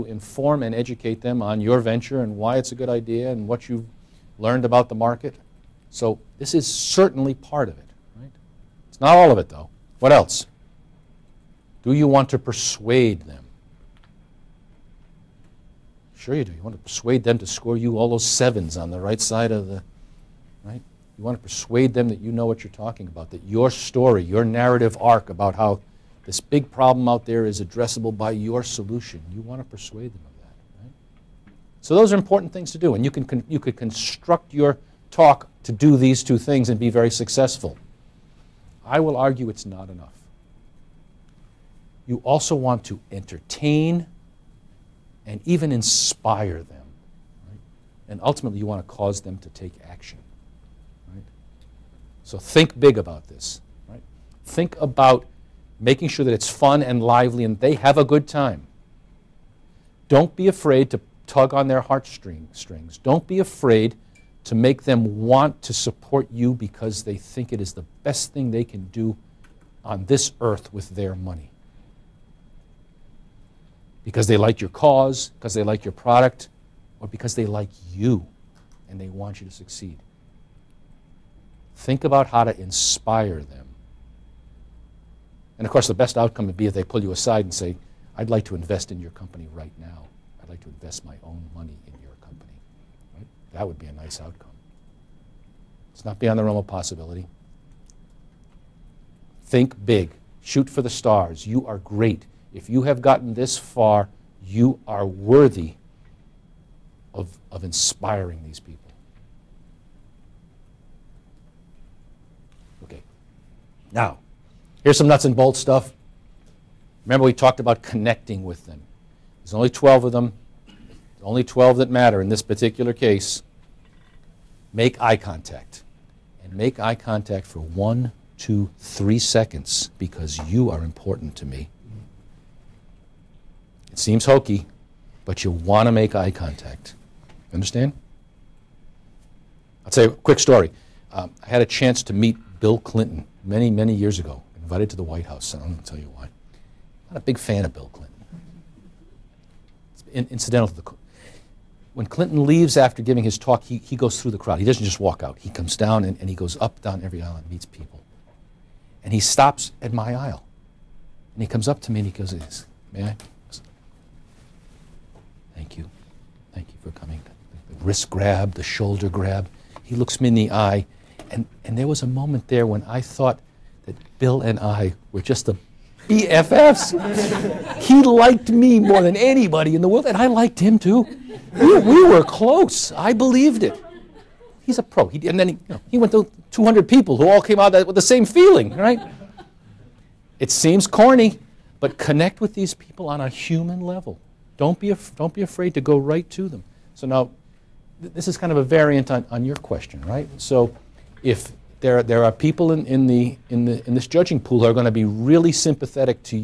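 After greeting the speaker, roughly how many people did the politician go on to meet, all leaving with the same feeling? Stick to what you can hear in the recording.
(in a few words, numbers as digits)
200.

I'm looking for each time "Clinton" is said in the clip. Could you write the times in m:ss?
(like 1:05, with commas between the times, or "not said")
2:22, 2:27, 2:32.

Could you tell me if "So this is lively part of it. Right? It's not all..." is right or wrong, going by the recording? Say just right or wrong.
wrong.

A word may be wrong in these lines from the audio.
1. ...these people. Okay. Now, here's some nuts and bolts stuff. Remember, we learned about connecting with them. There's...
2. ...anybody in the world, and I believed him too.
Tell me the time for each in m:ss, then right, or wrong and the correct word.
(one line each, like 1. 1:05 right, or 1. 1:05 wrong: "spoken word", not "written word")
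1. 1:48 wrong: "talked", not "learned"
2. 2:59 wrong: "liked", not "believed".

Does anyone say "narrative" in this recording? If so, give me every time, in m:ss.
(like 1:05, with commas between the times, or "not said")
0:24.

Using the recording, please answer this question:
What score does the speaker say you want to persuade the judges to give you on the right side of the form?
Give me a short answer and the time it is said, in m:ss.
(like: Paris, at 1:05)
7s, at 0:18.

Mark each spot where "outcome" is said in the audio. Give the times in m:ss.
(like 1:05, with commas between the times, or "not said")
1:26, 1:34.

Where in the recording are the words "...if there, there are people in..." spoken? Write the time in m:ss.
3:21.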